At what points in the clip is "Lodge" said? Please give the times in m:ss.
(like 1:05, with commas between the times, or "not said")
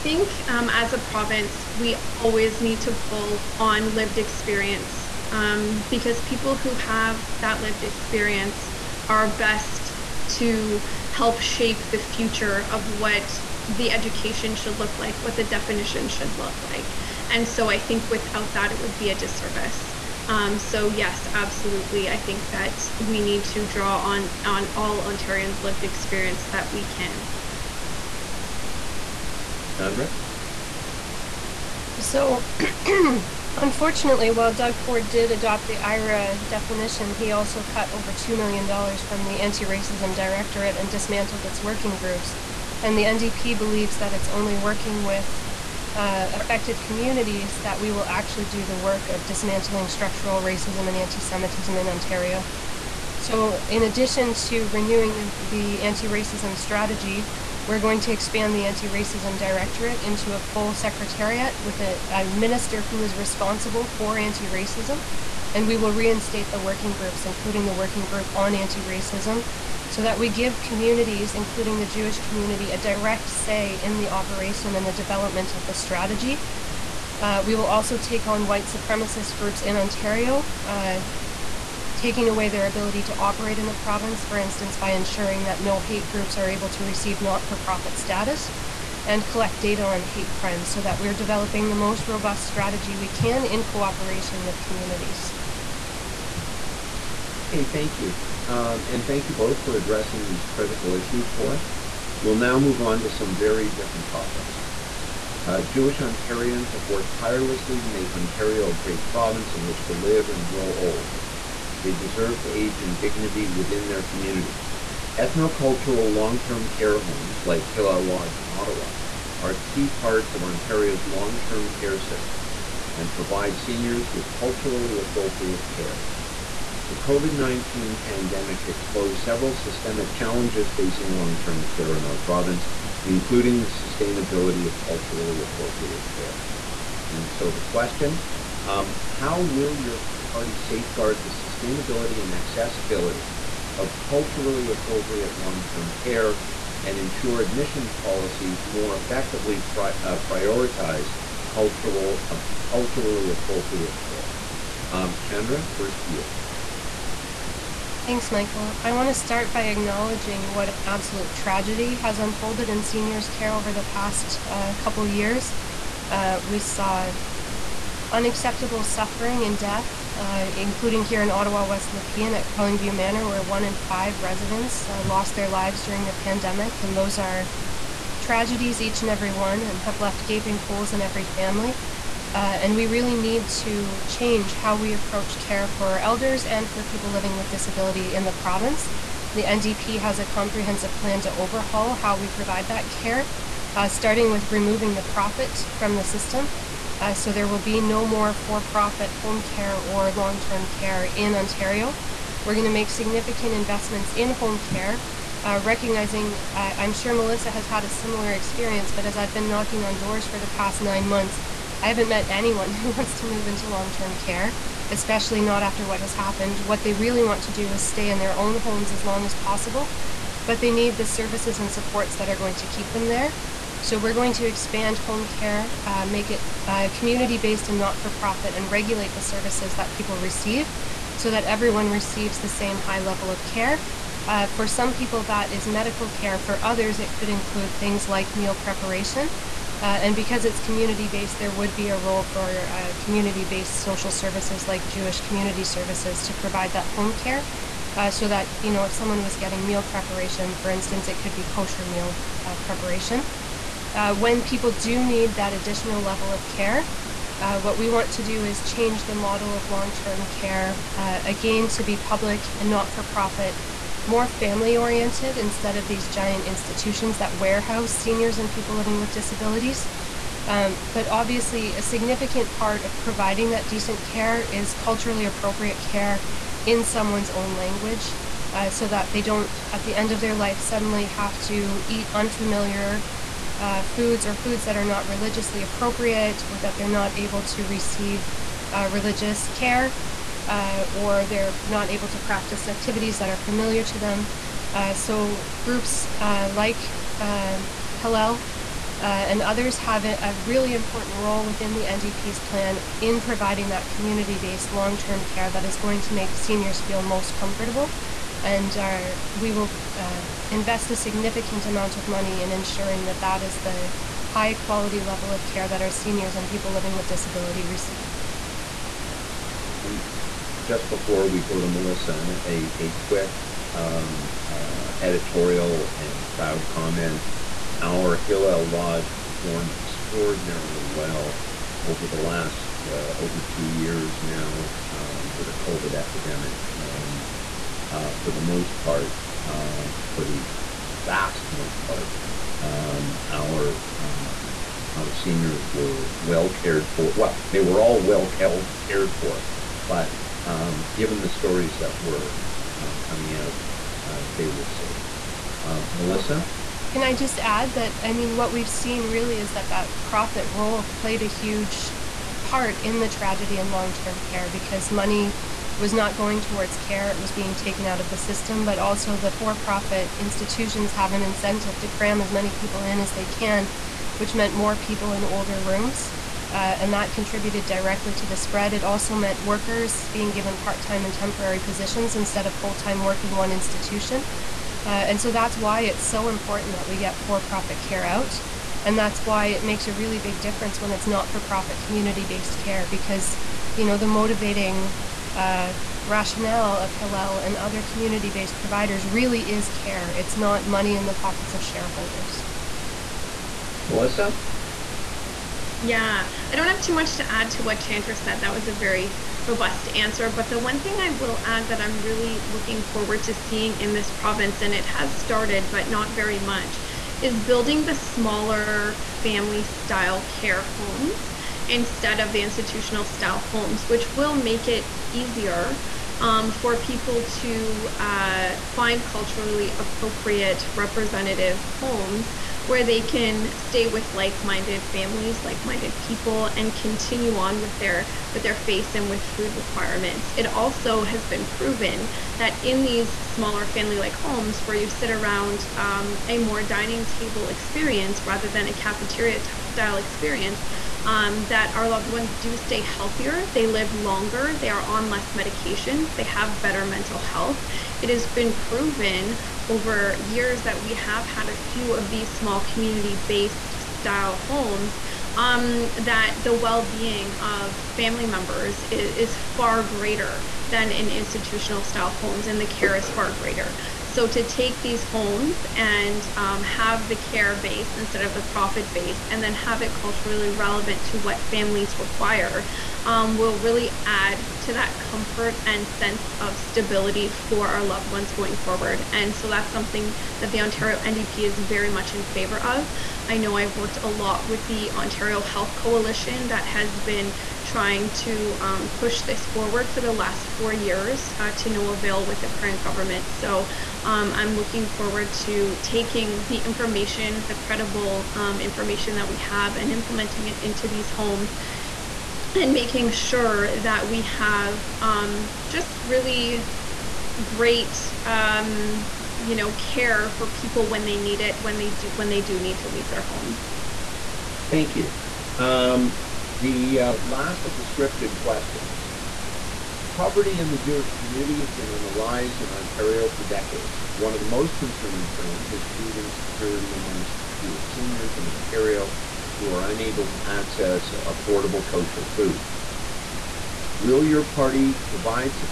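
1:58, 5:28.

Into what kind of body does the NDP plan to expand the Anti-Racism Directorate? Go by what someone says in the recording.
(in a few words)
A full secretariat.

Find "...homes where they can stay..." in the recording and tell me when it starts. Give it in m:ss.
7:11.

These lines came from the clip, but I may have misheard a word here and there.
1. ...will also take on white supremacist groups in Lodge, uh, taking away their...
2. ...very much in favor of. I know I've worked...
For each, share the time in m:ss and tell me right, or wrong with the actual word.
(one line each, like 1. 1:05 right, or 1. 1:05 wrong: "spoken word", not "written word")
1. 1:17 wrong: "Ontario", not "Lodge"
2. 8:11 right.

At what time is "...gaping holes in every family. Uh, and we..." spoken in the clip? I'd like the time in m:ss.
3:00.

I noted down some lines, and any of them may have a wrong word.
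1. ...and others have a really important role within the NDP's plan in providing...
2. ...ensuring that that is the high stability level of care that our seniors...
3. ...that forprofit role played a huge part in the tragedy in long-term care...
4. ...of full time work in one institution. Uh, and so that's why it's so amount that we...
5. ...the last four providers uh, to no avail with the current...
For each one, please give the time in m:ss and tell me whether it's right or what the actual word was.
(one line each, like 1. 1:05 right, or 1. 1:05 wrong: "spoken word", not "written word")
1. 4:59 right
2. 5:12 wrong: "quality", not "stability"
3. 5:59 wrong: "profit", not "forprofit"
4. 6:22 wrong: "important", not "amount"
5. 8:20 wrong: "years", not "providers".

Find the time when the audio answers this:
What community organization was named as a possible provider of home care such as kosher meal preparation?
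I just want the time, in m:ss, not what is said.
4:04.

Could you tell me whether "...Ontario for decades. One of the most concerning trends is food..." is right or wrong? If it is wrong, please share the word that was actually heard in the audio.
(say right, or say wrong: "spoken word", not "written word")
right.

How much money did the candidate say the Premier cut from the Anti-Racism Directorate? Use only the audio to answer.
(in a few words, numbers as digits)
Over $2 million.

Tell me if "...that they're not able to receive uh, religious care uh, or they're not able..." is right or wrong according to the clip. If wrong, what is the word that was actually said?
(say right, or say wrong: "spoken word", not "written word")
right.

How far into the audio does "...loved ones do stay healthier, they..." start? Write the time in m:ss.
7:31.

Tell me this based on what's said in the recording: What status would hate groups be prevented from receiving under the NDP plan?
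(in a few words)
Not-for-profit status.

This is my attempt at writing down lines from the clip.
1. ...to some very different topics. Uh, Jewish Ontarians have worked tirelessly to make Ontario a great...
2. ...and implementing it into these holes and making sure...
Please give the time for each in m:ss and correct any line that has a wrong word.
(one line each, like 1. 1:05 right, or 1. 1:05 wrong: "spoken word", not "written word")
1. 1:43 right
2. 8:29 wrong: "homes", not "holes".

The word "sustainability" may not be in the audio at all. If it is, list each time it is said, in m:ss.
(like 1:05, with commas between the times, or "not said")
2:13, 2:21.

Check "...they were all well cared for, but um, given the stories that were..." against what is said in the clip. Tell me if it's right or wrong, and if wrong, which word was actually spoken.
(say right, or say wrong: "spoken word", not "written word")
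right.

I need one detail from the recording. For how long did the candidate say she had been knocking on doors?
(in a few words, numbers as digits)
Nine months.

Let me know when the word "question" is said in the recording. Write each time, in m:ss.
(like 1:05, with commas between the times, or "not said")
2:17, 8:48.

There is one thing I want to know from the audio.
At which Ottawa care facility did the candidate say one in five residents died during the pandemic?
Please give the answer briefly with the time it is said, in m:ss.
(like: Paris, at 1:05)
Carlingview Manor, at 2:52.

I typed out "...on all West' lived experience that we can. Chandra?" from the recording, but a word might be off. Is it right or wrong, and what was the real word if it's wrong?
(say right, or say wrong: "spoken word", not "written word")
wrong: "Ontarians", not "West".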